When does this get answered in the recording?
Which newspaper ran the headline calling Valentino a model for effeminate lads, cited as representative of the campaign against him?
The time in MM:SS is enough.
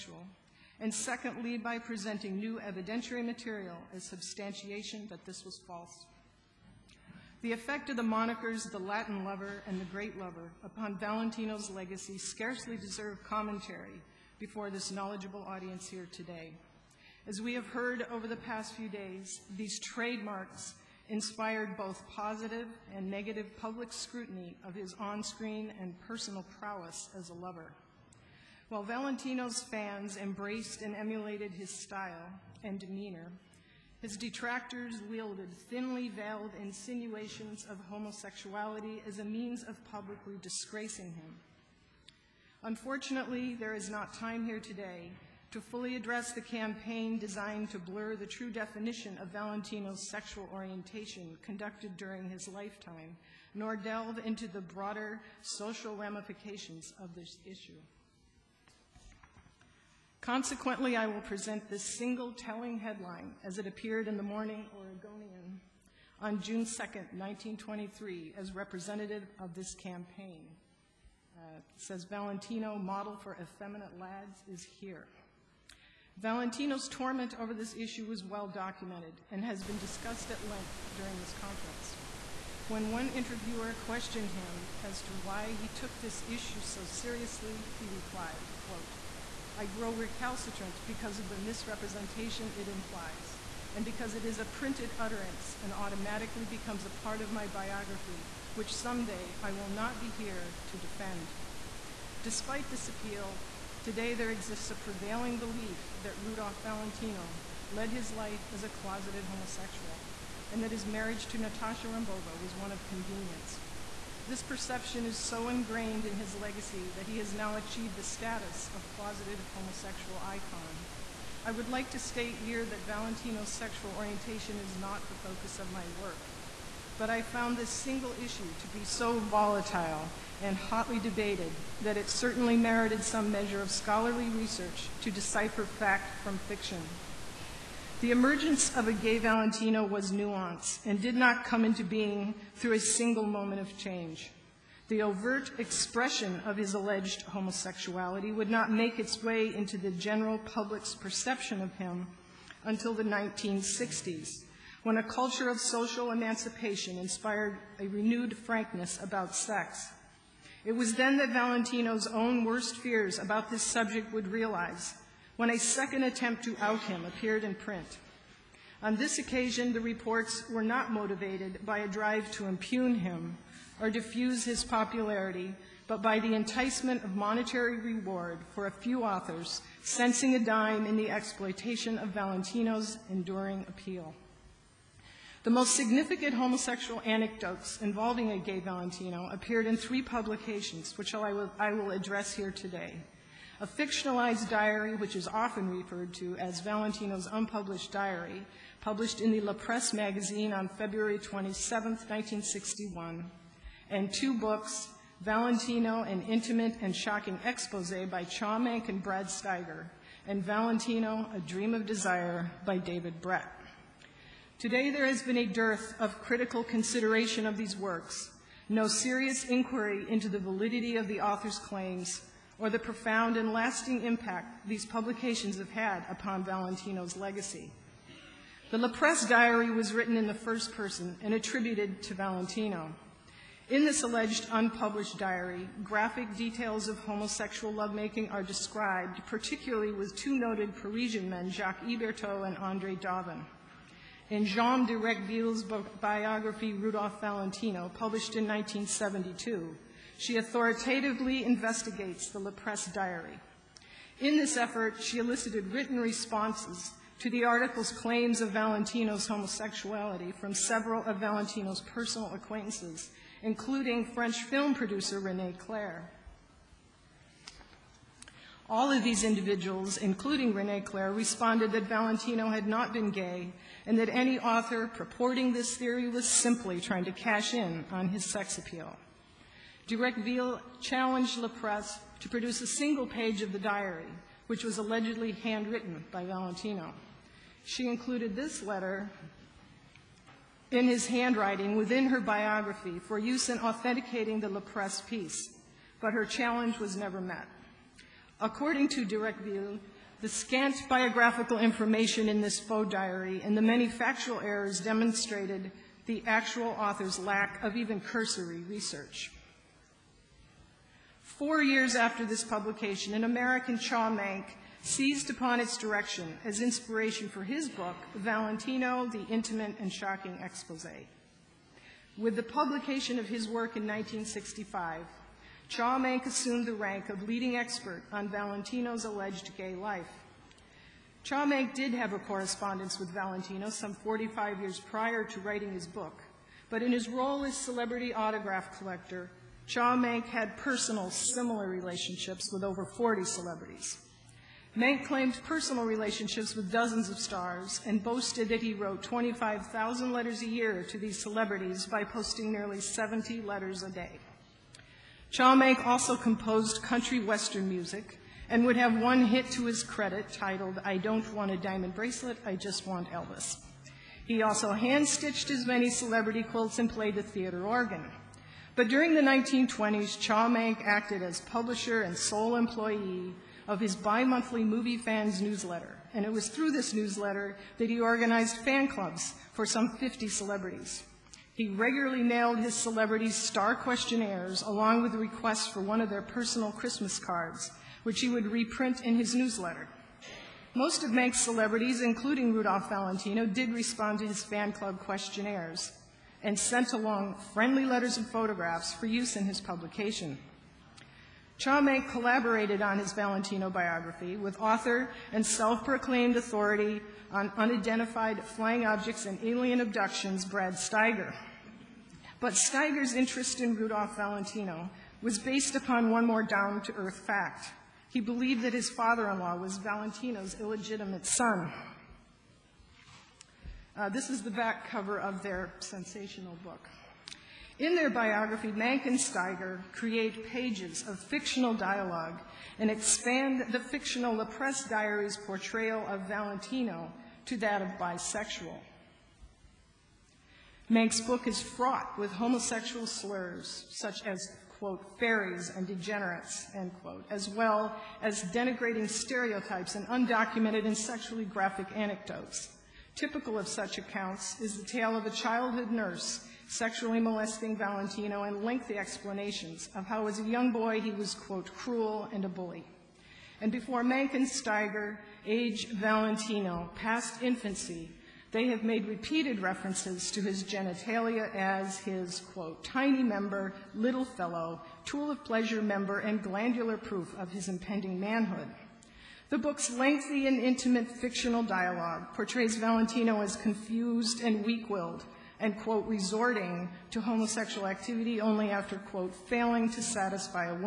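01:04.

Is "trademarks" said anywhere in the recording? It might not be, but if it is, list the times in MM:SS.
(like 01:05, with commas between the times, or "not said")
00:19.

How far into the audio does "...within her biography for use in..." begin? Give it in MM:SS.
04:51.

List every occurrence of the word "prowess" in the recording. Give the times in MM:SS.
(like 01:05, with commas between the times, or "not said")
00:26.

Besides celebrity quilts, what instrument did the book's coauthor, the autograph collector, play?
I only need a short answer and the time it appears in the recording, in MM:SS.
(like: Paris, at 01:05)
theater organ, at 06:07.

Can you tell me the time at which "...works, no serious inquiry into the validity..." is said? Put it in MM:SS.
03:37.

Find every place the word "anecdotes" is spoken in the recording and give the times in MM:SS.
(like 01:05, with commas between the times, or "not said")
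03:07, 07:31.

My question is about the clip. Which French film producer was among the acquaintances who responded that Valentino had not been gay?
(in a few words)
René Clair.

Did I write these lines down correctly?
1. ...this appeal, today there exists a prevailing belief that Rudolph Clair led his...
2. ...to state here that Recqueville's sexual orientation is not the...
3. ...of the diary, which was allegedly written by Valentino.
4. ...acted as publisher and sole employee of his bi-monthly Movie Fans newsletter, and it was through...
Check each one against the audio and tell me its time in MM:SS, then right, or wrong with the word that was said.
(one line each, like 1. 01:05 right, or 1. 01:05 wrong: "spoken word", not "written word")
1. 01:42 wrong: "Valentino", not "Clair"
2. 02:01 wrong: "Valentino", not "Recqueville"
3. 04:43 wrong: "handwritten", not "written"
4. 06:10 right.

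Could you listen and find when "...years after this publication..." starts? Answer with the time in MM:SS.
05:11.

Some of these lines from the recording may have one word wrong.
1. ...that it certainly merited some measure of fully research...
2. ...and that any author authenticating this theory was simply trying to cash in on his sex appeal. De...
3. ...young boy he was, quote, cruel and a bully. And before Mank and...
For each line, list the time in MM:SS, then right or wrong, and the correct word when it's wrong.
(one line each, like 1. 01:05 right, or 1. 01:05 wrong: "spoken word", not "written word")
1. 02:11 wrong: "scholarly", not "fully"
2. 04:33 wrong: "purporting", not "authenticating"
3. 07:40 right.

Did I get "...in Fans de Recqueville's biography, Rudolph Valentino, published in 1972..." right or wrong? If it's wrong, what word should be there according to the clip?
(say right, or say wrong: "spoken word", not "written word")
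wrong: "Jeanne", not "Fans".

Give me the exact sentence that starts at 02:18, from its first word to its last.
The emergence of a gay Valentino was nuanced and did not come into being through a single moment of change.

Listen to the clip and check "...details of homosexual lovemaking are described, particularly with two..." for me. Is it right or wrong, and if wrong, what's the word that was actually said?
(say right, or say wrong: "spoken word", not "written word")
right.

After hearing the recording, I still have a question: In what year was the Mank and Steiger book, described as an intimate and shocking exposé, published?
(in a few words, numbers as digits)
1965.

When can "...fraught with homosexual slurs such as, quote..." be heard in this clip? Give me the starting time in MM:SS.
07:21.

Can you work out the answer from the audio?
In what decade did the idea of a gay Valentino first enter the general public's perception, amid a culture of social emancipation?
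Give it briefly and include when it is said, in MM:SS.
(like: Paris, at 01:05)
1960s, at 02:33.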